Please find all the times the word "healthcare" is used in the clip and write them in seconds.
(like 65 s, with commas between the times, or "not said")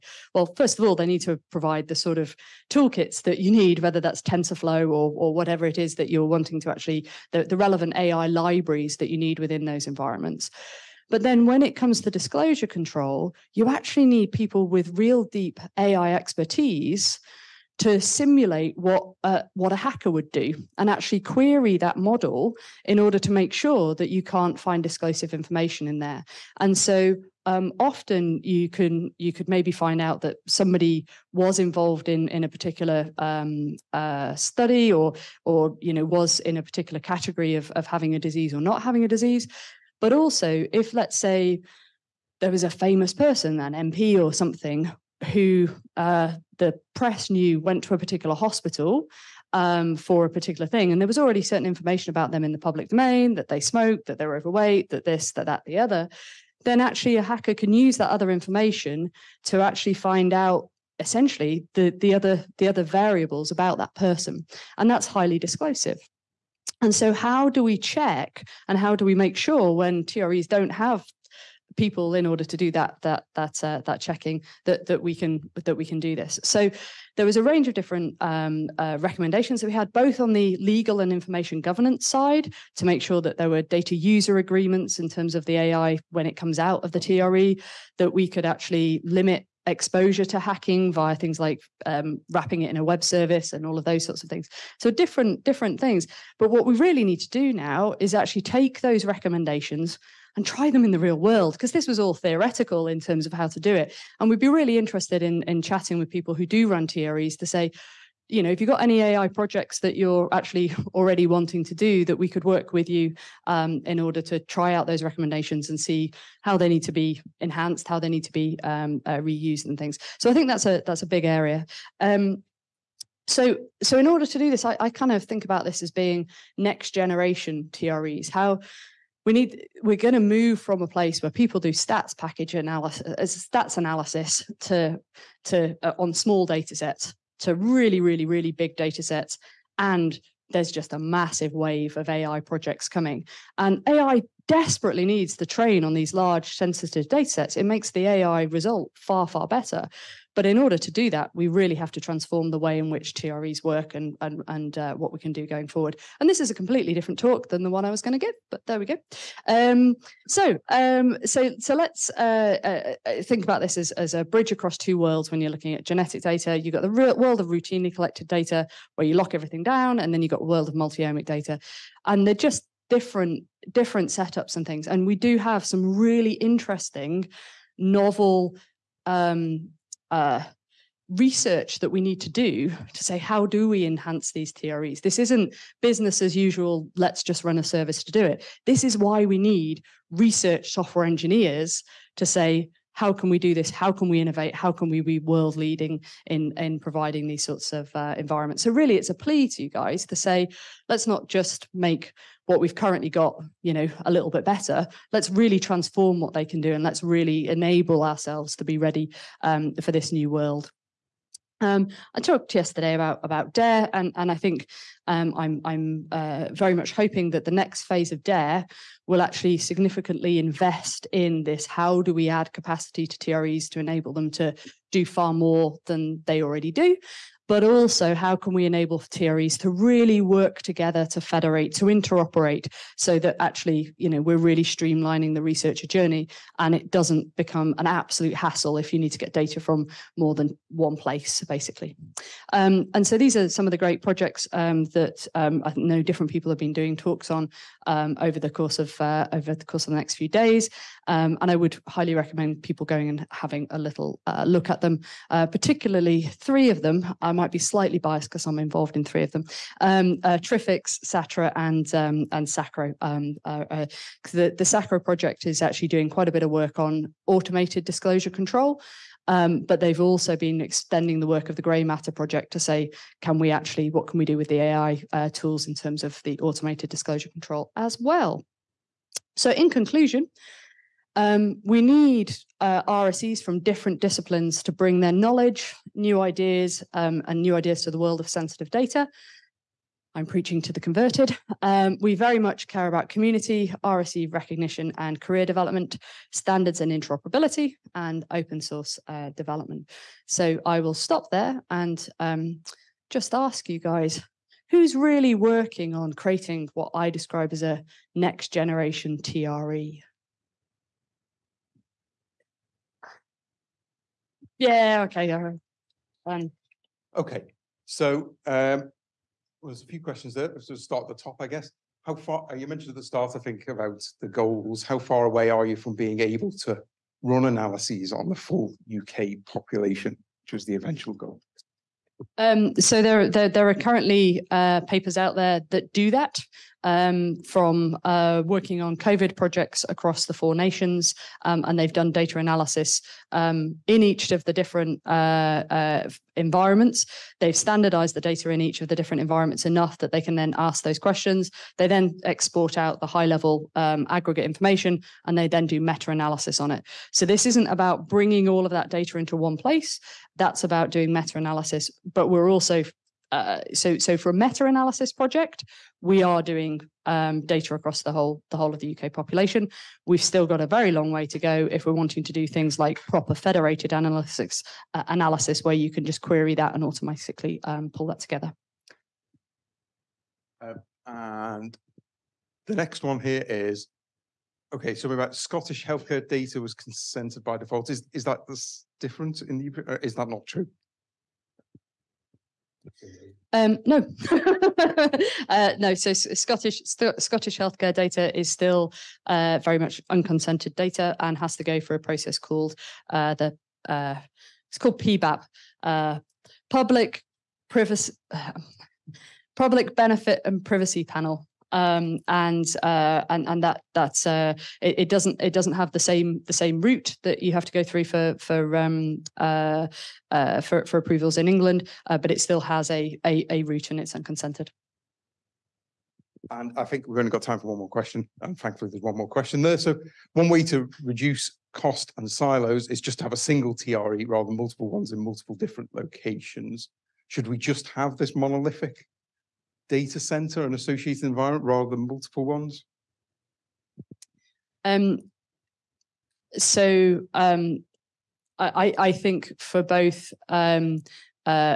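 385 s, 397 s.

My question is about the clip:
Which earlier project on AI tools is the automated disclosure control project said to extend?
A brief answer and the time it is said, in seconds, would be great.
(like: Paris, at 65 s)
GRAIMatter project, at 271 s.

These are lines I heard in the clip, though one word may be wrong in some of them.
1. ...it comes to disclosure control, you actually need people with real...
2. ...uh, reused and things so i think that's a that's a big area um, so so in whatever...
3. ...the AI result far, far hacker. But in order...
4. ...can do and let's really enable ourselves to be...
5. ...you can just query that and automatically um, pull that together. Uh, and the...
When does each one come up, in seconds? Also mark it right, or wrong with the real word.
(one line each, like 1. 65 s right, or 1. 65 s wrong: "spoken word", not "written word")
1. 11 s right
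2. 119 s wrong: "order", not "whatever"
3. 147 s wrong: "better", not "hacker"
4. 206 s right
5. 375 s right.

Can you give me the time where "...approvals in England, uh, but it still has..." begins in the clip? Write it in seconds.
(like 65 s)
420 s.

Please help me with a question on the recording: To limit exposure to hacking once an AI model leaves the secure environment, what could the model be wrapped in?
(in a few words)
a web service.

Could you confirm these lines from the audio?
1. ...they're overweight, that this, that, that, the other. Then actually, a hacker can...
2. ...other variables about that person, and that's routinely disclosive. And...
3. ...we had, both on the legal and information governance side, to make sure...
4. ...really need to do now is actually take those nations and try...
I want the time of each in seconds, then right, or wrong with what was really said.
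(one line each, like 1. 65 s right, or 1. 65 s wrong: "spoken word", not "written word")
1. 54 s right
2. 62 s wrong: "highly", not "routinely"
3. 79 s right
4. 96 s wrong: "recommendations", not "nations".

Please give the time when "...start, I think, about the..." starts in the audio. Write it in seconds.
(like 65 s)
323 s.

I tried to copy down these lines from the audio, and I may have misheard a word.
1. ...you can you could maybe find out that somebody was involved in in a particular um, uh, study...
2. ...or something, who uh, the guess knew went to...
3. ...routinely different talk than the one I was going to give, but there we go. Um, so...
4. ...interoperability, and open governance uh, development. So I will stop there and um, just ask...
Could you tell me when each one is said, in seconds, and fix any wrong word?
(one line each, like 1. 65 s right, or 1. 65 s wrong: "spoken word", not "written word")
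1. 28 s right
2. 44 s wrong: "press", not "guess"
3. 156 s wrong: "completely", not "routinely"
4. 296 s wrong: "source", not "governance".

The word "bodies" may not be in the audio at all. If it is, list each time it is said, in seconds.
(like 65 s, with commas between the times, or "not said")
not said.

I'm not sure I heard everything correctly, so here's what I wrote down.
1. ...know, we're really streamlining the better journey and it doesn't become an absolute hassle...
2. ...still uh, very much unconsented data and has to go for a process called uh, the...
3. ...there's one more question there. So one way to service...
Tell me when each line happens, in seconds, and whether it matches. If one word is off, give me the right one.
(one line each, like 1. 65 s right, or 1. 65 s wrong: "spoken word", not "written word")
1. 234 s wrong: "researcher", not "better"
2. 398 s right
3. 428 s wrong: "reduce", not "service".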